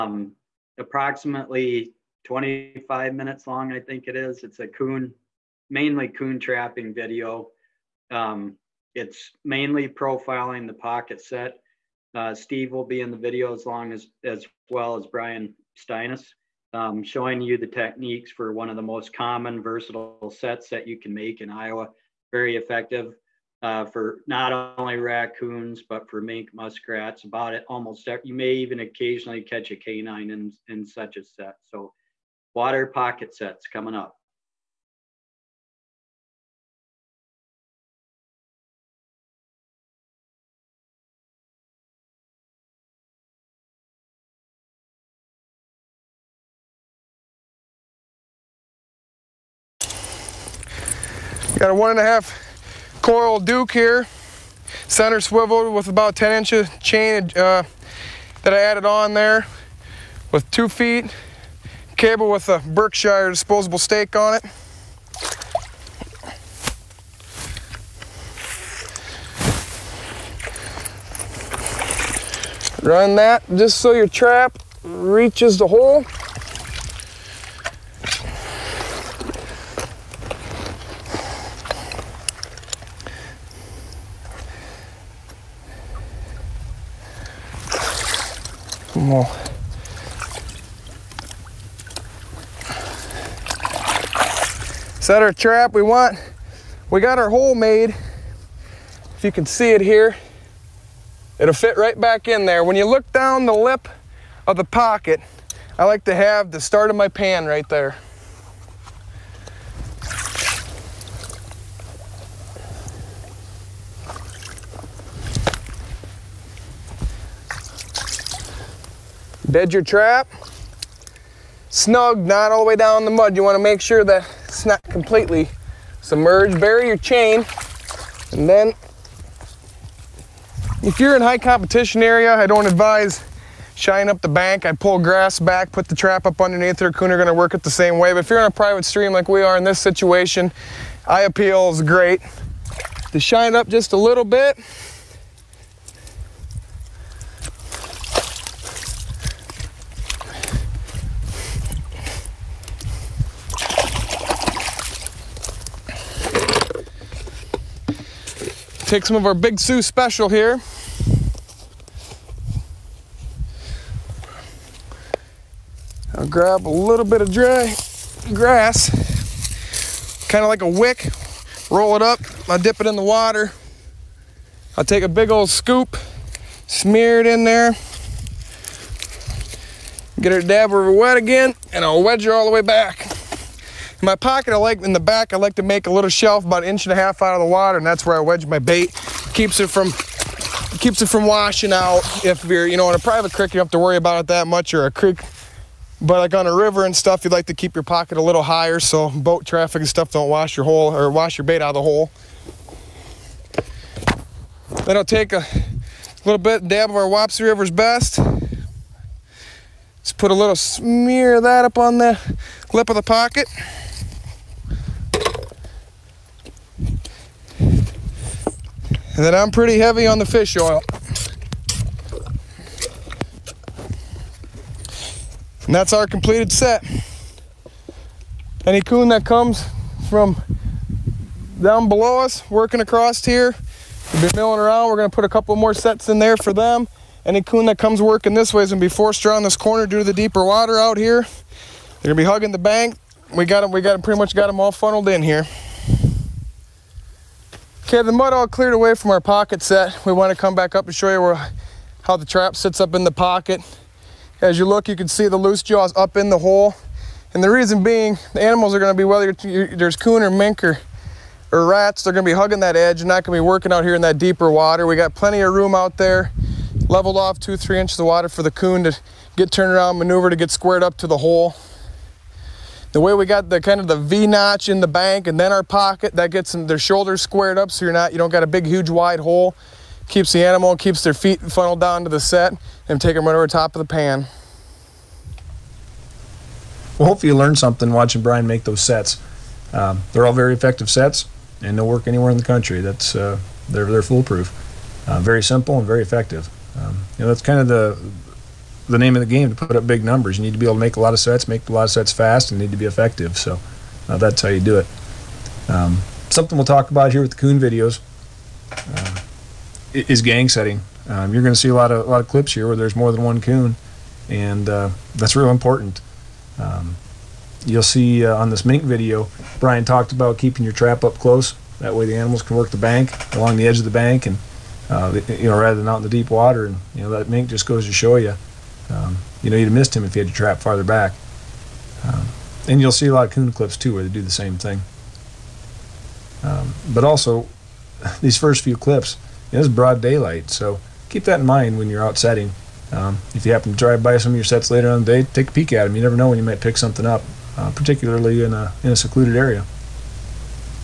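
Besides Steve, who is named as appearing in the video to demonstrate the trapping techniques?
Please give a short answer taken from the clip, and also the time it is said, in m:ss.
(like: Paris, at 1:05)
Brian Steinus, at 0:15.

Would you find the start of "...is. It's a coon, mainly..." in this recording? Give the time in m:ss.
0:04.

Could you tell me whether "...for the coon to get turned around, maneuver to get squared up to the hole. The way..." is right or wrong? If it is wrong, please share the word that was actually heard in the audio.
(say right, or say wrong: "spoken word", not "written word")
right.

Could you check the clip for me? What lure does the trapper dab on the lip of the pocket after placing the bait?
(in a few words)
Wapsie River's Best.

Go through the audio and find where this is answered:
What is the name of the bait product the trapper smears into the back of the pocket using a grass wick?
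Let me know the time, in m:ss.
2:39.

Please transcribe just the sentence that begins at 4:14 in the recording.
As you look, you can see the loose jaws up in the hole.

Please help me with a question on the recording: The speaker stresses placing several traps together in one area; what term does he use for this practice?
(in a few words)
gang setting.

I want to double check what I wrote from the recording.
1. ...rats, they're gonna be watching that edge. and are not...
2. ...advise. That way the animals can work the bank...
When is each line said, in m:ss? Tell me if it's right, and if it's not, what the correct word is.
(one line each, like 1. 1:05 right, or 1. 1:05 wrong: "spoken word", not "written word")
1. 4:21 wrong: "hugging", not "watching"
2. 5:21 wrong: "close", not "advise".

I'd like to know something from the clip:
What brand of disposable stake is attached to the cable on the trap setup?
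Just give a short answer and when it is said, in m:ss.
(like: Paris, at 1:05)
Berkshire, at 1:02.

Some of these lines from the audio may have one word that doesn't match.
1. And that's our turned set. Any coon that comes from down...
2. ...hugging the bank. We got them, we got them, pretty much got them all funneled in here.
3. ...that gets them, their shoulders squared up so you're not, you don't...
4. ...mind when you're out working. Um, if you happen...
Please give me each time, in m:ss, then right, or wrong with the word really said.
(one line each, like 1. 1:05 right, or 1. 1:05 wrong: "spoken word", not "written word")
1. 3:45 wrong: "completed", not "turned"
2. 4:02 right
3. 4:36 right
4. 5:41 wrong: "setting", not "working".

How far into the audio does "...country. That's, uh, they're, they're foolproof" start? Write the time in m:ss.
4:52.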